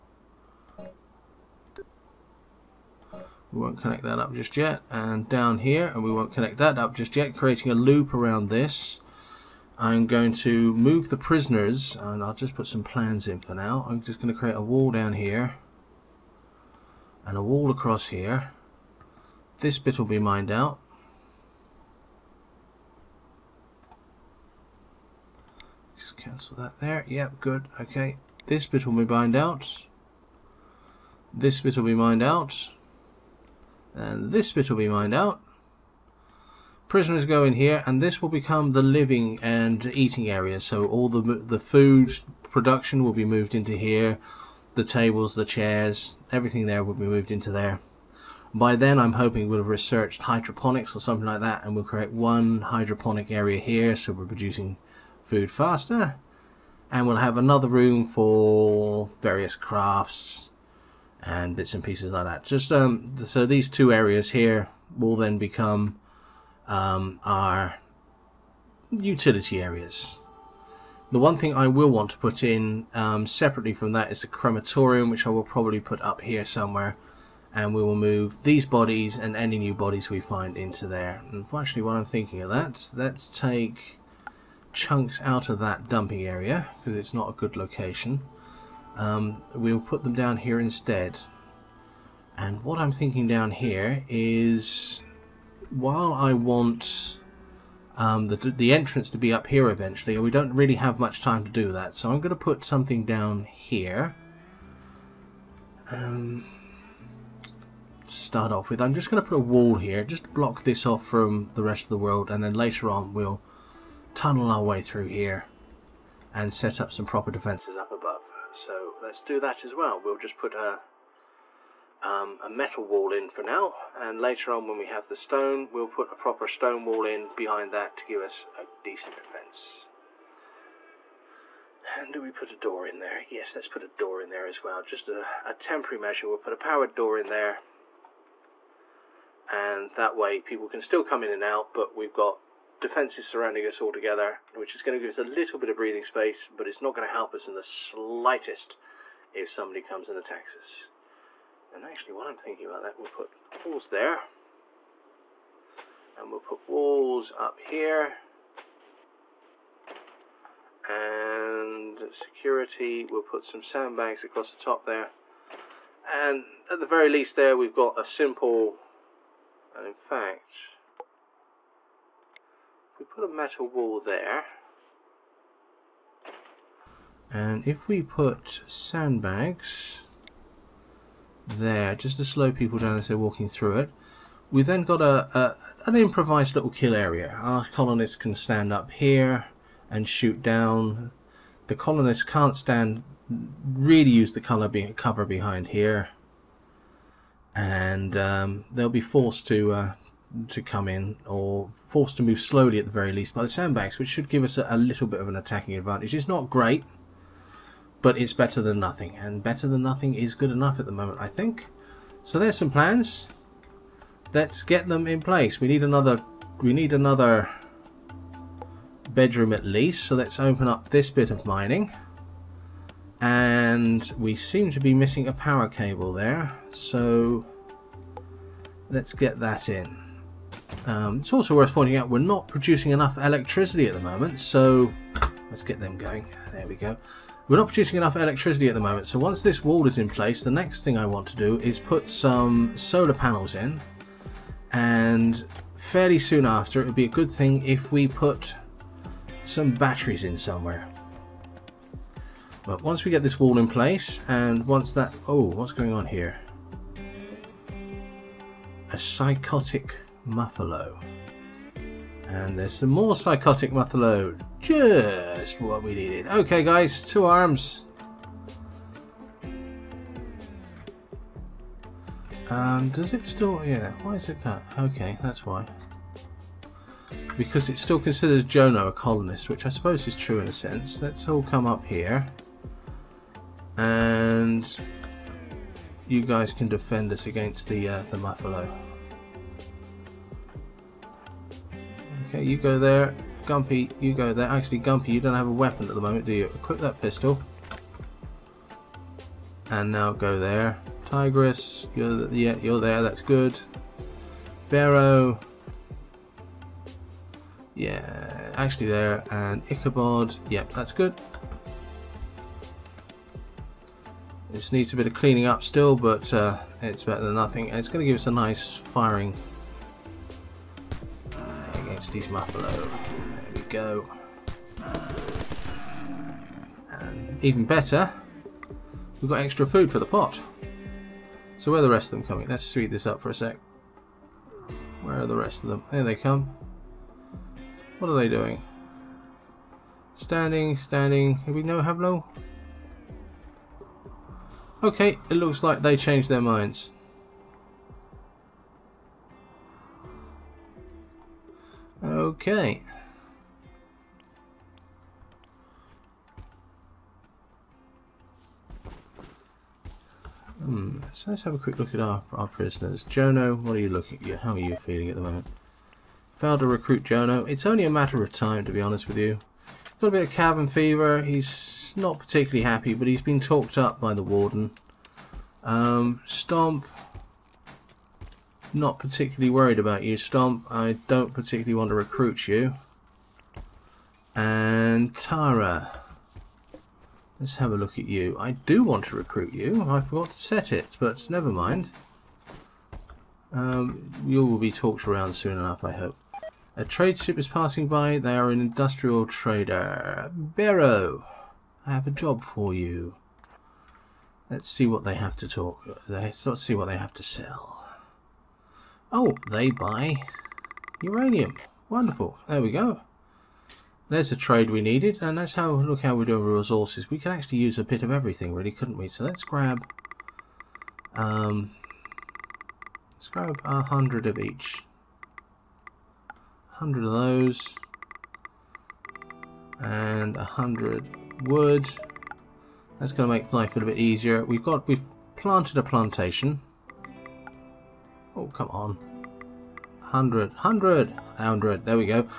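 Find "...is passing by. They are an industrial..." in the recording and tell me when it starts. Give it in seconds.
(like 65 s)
397 s.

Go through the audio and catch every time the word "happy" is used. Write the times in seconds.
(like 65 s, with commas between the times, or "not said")
372 s.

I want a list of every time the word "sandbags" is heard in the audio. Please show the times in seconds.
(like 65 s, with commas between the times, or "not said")
163 s, 178 s, 203 s.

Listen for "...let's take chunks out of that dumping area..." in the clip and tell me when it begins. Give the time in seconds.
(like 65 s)
82 s.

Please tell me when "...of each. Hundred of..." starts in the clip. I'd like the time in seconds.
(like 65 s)
424 s.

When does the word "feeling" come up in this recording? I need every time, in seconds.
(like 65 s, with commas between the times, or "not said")
364 s.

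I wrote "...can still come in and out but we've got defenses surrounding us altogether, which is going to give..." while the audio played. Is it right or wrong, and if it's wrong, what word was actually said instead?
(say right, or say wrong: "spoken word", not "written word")
right.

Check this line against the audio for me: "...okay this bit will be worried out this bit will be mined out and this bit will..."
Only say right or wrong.
wrong.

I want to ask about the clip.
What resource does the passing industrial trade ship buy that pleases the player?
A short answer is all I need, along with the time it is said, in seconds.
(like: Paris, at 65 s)
Uranium, at 411 s.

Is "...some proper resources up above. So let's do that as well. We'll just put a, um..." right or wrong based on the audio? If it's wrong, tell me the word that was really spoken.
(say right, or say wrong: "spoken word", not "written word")
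wrong: "defences", not "resources".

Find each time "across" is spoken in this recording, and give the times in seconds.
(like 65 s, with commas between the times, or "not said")
17 s, 164 s.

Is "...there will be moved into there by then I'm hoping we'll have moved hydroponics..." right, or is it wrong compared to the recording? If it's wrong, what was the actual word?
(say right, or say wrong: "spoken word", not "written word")
wrong: "researched", not "moved".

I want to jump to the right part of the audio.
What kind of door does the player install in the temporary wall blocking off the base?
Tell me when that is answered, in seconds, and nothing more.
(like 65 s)
136 s.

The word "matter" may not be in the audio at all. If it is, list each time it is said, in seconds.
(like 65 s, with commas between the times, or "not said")
367 s.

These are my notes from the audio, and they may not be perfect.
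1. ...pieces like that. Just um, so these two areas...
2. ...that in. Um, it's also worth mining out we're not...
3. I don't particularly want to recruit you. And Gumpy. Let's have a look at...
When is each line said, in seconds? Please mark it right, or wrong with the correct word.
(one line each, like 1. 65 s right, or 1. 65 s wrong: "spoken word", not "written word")
1. 61 s right
2. 229 s wrong: "pointing", not "mining"
3. 380 s wrong: "Tara", not "Gumpy".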